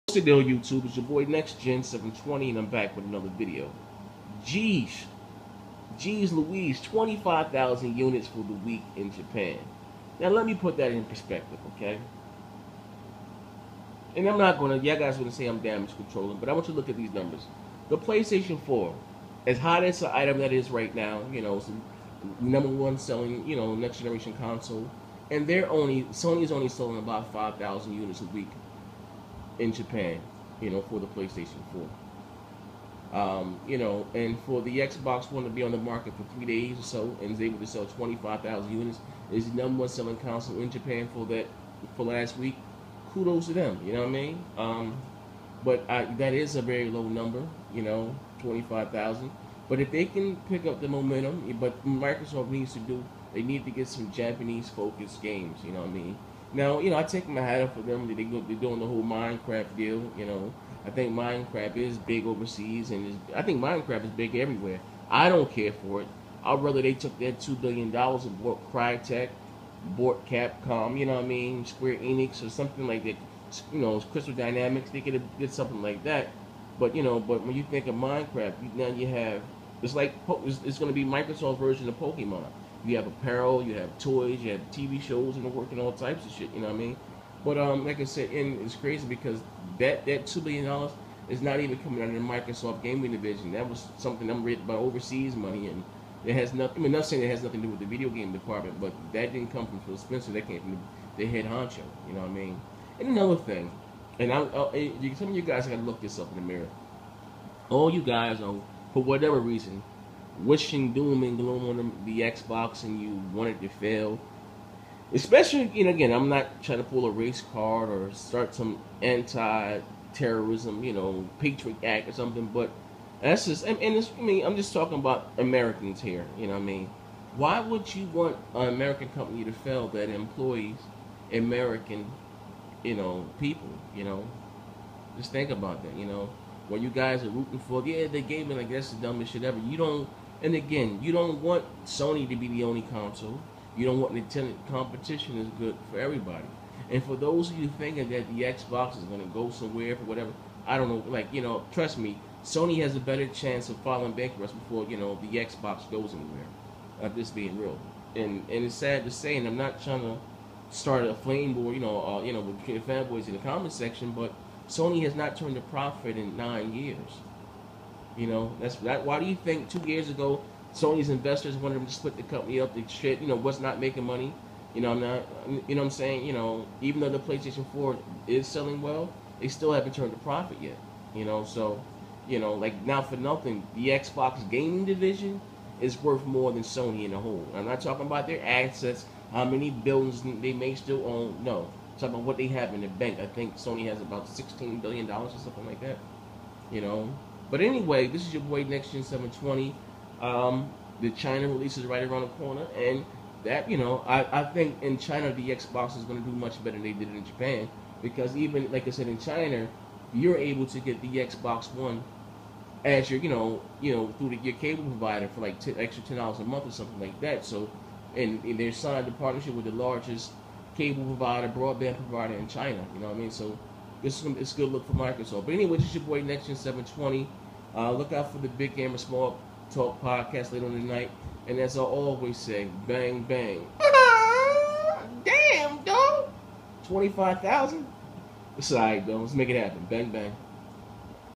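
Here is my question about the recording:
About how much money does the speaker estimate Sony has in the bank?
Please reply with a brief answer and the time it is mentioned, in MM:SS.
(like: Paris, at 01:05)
$16 billion, at 03:14.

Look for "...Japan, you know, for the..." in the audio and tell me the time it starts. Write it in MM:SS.
00:29.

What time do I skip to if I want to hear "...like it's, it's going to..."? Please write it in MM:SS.
01:19.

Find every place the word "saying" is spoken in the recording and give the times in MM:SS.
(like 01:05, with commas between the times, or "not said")
01:37, 02:55.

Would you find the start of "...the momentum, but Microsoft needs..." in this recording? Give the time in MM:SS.
00:50.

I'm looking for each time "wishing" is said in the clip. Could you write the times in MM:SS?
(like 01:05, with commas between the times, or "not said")
01:50.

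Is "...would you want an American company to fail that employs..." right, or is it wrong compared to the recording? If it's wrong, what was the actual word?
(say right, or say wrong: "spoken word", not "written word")
right.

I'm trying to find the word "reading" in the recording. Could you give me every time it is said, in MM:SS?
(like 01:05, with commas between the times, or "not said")
01:34.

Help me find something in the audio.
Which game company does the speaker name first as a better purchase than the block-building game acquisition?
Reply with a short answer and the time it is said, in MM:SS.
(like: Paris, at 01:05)
Crytek, at 01:08.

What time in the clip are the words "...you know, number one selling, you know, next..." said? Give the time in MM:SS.
00:21.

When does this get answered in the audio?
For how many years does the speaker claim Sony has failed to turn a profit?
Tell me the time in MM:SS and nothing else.
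02:46.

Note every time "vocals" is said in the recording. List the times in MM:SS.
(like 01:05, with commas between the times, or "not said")
not said.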